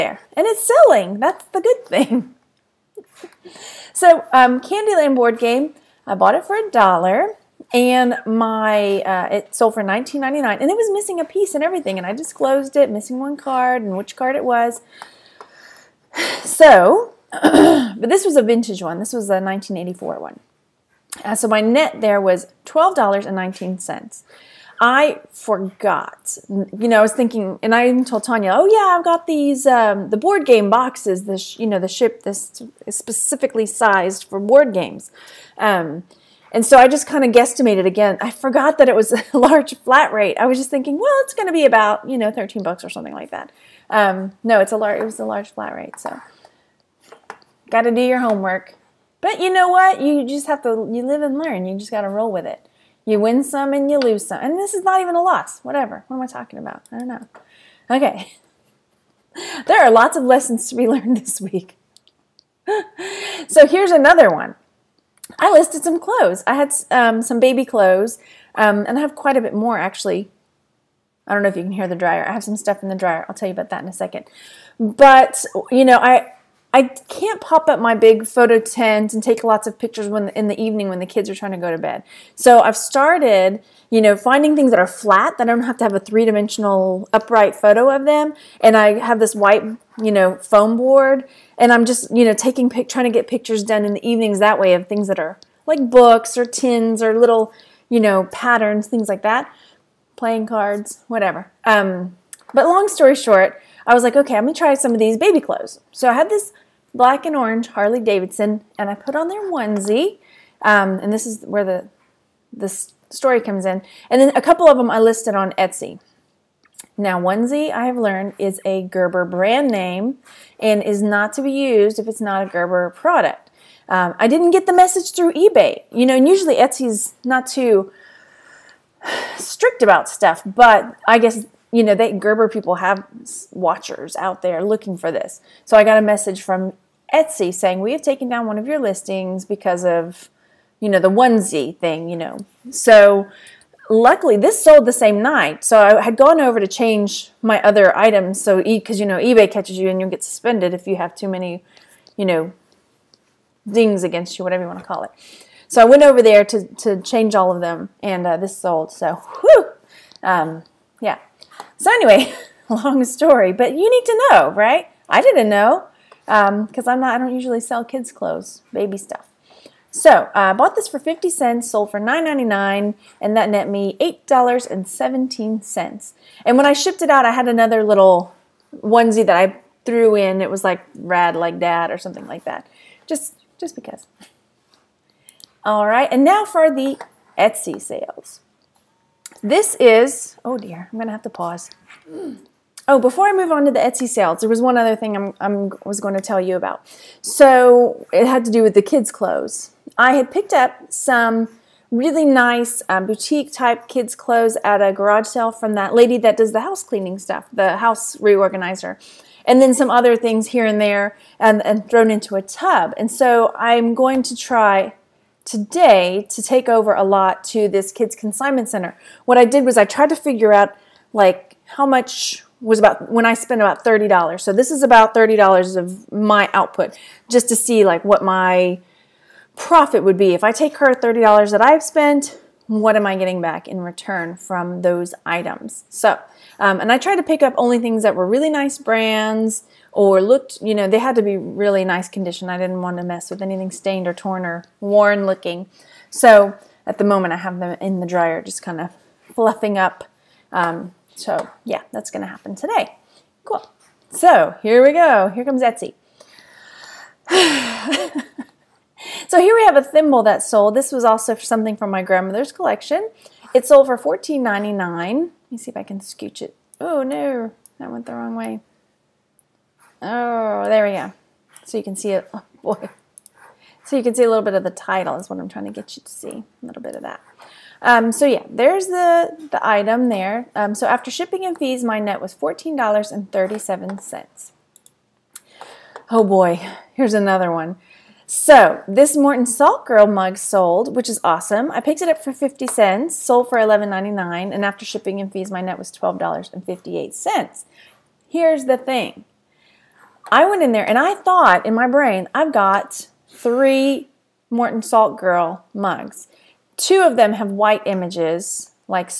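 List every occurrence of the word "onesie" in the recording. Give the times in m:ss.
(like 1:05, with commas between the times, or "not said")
1:49, 1:57, 2:21, 2:58.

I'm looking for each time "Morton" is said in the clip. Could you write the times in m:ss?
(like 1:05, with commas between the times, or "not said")
4:49, 5:04.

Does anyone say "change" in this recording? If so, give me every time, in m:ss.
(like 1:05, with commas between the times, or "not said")
2:26, 2:37.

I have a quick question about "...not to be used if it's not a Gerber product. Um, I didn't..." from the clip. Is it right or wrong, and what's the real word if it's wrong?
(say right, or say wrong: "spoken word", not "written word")
right.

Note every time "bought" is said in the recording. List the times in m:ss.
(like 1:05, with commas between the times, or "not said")
0:06, 2:50.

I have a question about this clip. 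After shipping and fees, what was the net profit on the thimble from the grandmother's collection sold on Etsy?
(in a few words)
$14.37.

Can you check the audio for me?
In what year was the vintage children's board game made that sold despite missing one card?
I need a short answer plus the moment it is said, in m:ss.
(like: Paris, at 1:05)
1984, at 0:19.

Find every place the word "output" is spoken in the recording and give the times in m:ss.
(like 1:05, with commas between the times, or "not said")
3:46.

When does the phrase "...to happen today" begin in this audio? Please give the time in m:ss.
4:12.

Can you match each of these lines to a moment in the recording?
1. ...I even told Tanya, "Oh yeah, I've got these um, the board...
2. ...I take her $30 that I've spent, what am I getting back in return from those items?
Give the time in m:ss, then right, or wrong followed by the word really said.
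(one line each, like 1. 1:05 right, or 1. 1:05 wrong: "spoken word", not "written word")
1. 0:27 right
2. 3:50 right.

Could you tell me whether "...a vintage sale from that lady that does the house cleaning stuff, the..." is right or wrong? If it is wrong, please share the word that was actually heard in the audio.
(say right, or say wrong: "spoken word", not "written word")
wrong: "garage", not "vintage".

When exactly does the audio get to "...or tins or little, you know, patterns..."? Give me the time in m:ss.
1:36.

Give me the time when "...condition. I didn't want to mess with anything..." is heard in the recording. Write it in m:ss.
4:02.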